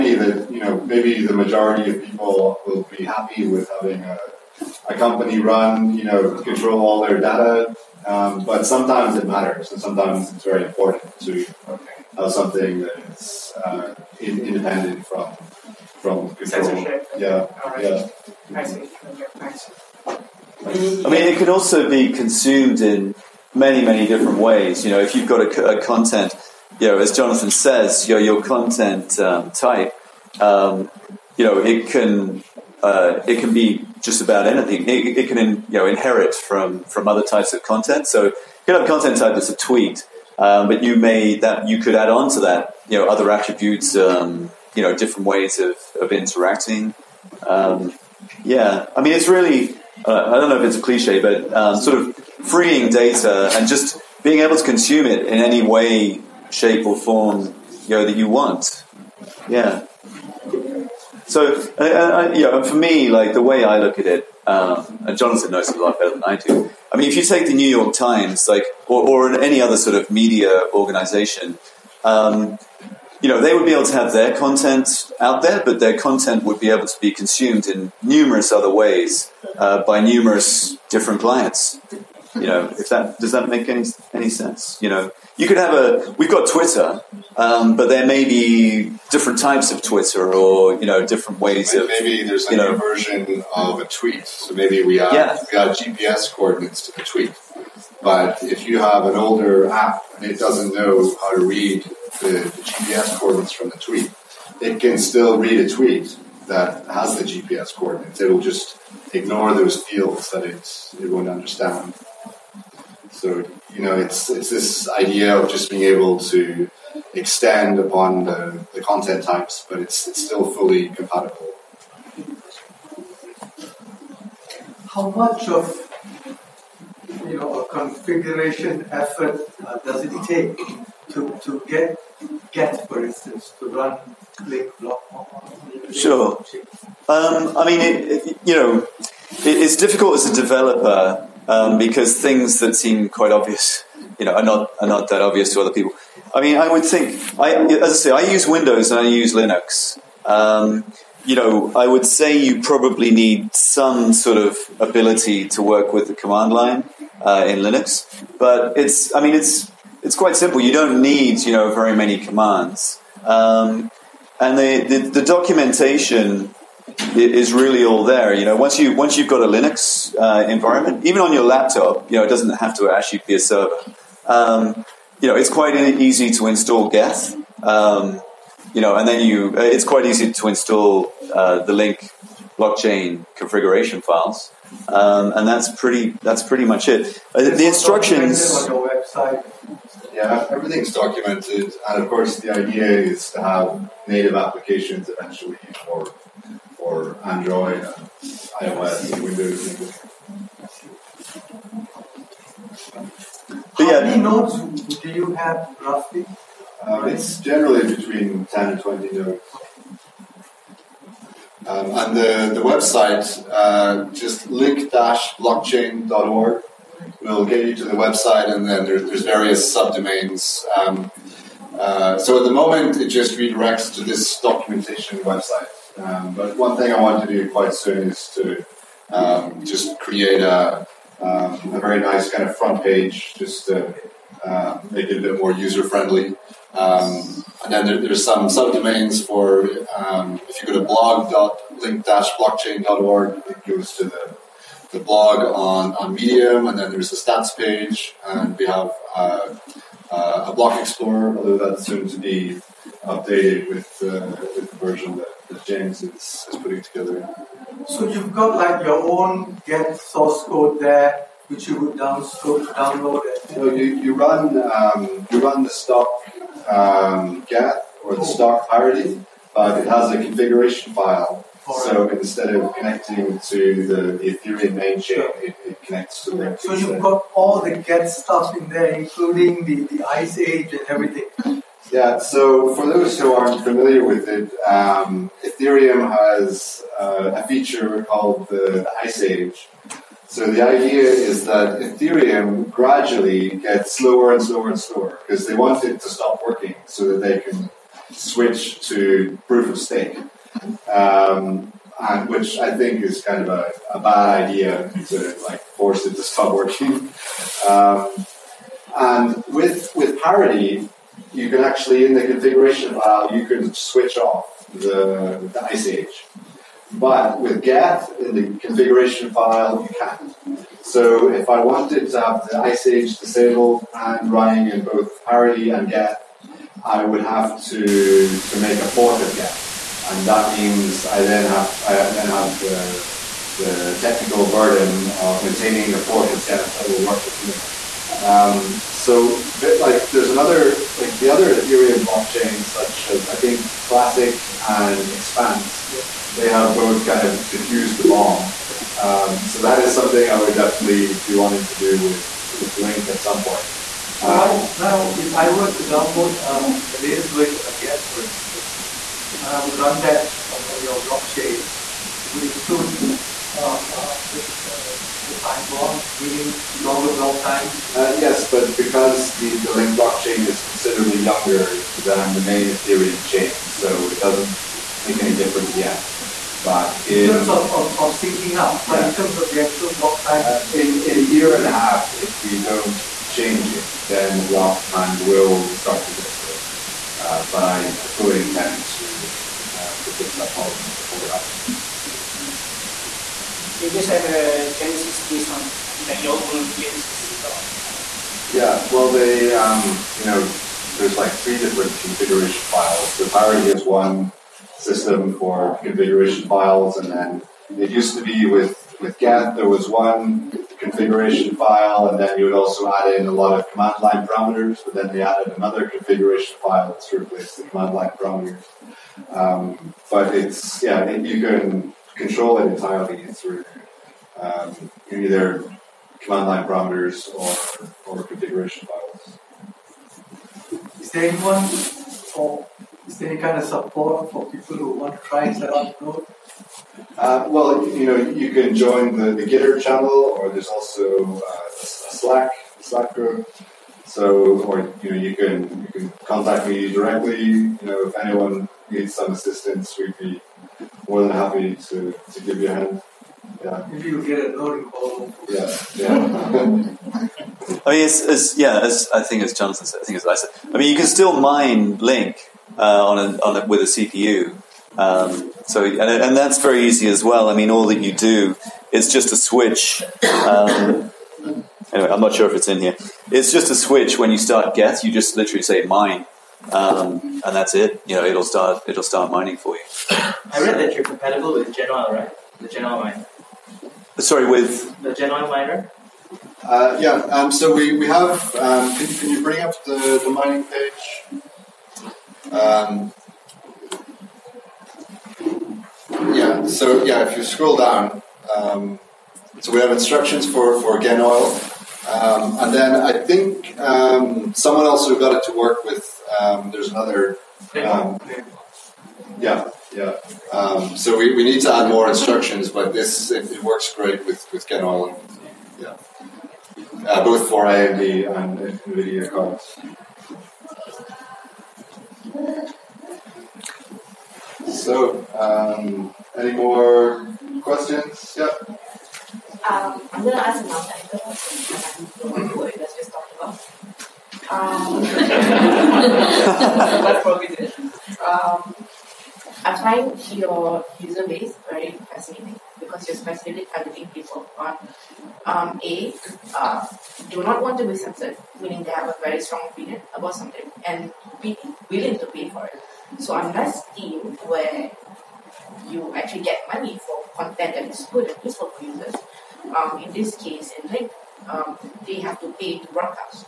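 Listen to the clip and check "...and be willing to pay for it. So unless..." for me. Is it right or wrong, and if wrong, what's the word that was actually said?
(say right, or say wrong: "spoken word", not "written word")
right.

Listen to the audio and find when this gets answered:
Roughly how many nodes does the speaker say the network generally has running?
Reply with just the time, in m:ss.
3:27.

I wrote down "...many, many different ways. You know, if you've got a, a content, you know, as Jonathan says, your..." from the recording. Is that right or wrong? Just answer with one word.
right.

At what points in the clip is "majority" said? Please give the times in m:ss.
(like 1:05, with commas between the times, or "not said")
0:01.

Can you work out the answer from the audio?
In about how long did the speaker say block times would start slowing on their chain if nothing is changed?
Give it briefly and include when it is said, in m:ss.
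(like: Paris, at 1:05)
a year and a half, at 6:21.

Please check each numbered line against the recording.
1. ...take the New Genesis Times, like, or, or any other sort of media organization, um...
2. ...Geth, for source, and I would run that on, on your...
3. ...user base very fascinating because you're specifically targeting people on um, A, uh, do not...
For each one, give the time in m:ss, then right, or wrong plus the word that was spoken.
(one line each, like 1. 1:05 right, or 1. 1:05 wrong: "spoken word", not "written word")
1. 1:07 wrong: "York", not "Genesis"
2. 5:57 wrong: "instance", not "source"
3. 9:00 right.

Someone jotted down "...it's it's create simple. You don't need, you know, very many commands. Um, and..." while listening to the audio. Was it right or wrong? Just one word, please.
wrong.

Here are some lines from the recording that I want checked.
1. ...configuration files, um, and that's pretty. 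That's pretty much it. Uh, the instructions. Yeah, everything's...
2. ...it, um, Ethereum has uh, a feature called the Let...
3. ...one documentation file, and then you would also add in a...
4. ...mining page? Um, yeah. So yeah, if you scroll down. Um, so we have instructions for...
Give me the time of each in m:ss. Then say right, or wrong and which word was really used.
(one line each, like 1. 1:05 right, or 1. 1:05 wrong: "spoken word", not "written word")
1. 3:03 right
2. 4:44 wrong: "Ice", not "Let"
3. 6:49 wrong: "configuration", not "documentation"
4. 8:10 right.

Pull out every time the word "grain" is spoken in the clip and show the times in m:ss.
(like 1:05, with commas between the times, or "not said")
not said.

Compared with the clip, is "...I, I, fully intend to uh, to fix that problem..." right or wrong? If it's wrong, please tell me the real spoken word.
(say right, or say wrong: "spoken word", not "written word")
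right.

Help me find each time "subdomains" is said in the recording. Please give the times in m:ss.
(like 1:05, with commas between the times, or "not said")
3:39, 3:58.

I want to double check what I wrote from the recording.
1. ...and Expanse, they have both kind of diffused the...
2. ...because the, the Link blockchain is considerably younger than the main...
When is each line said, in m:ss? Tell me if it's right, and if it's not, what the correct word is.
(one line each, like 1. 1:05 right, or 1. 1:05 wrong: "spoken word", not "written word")
1. 5:44 right
2. 6:08 right.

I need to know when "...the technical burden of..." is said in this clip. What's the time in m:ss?
5:33.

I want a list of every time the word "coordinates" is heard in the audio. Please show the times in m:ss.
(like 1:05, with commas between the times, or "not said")
1:36, 1:43, 1:47.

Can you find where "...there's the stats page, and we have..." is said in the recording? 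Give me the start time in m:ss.
4:06.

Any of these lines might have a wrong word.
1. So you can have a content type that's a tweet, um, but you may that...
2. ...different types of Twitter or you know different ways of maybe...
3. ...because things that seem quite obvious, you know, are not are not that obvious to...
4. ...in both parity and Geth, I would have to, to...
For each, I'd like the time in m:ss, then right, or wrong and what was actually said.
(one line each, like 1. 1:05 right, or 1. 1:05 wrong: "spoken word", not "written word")
1. 0:38 right
2. 1:29 right
3. 2:21 right
4. 5:24 right.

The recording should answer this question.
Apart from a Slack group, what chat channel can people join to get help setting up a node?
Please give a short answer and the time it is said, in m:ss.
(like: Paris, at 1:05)
Gitter, at 7:19.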